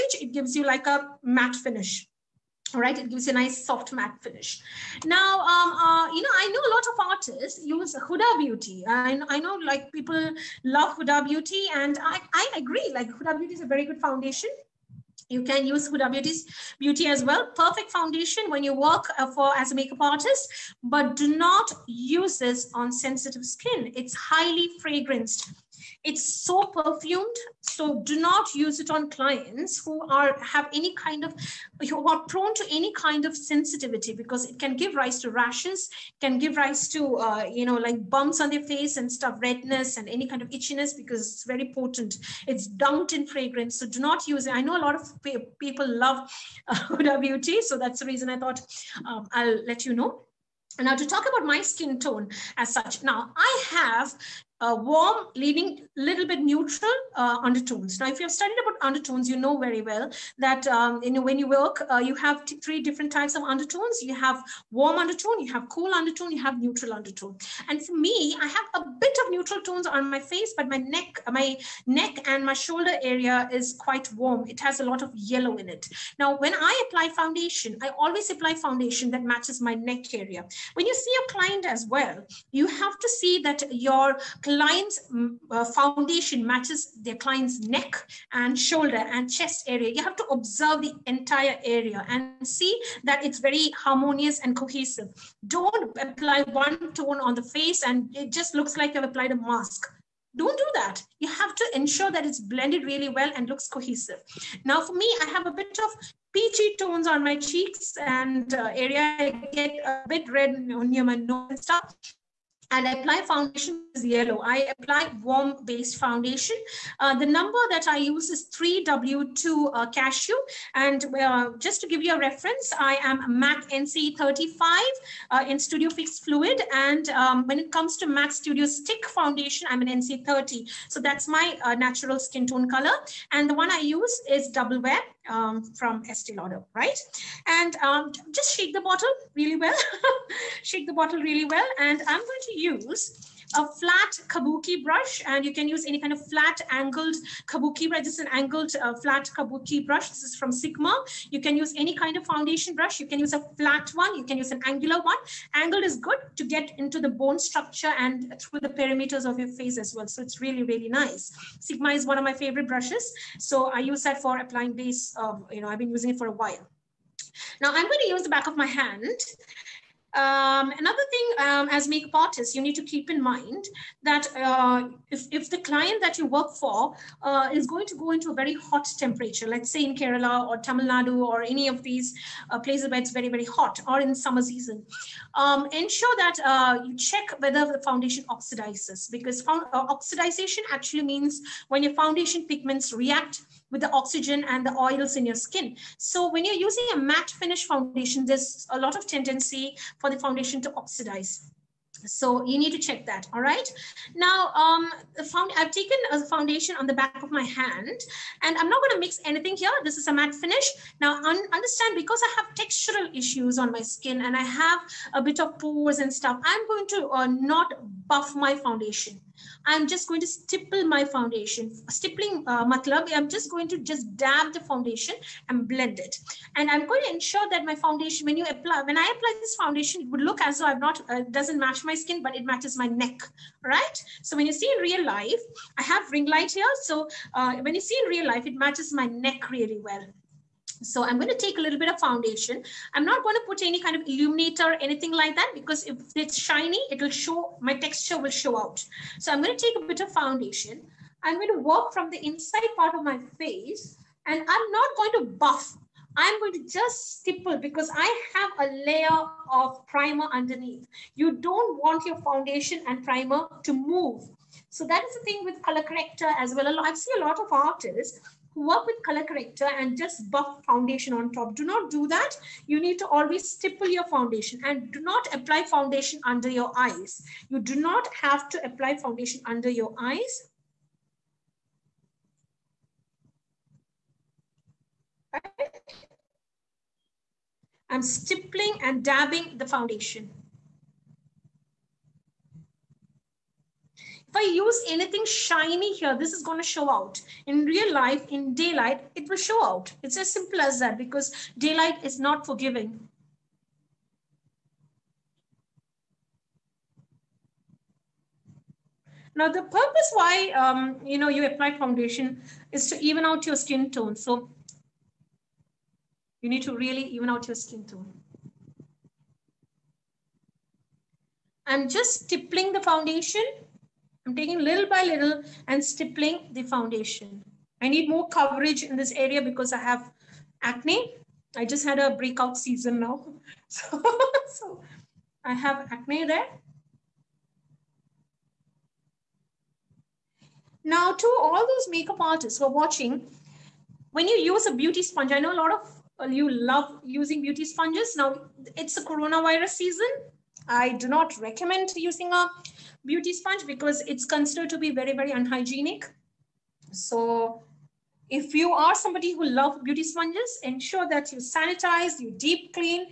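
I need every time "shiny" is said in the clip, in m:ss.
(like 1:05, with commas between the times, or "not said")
4:06, 4:55.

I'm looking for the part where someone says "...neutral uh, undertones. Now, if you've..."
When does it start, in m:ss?
0:56.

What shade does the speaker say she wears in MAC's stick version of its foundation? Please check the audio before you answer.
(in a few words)
NC30.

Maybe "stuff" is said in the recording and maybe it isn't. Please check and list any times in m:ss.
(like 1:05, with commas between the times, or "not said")
0:39, 1:51, 3:36.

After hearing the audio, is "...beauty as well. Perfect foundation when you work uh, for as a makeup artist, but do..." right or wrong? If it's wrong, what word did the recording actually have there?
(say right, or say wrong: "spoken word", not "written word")
right.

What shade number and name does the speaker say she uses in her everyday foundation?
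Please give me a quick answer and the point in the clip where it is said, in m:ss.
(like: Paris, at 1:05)
3W2 Cashew, at 1:58.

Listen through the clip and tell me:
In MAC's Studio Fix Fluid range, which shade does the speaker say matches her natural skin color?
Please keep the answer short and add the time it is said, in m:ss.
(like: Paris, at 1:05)
NC35, at 2:03.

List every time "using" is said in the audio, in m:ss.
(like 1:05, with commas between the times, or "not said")
2:45, 3:16, 5:47, 5:51.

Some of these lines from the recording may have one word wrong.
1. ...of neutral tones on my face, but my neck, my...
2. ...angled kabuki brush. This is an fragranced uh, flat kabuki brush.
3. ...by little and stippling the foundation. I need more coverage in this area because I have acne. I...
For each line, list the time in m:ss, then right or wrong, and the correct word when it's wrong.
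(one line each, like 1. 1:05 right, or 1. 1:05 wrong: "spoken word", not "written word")
1. 1:09 right
2. 2:26 wrong: "angled", not "fragranced"
3. 5:24 right.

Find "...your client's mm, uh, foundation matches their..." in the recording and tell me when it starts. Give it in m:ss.
1:23.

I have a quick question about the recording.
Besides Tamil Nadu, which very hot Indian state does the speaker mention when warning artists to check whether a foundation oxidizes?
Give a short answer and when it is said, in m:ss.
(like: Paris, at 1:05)
Kerala, at 2:59.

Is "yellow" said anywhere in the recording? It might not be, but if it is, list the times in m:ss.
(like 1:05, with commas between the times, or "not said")
1:15, 1:54.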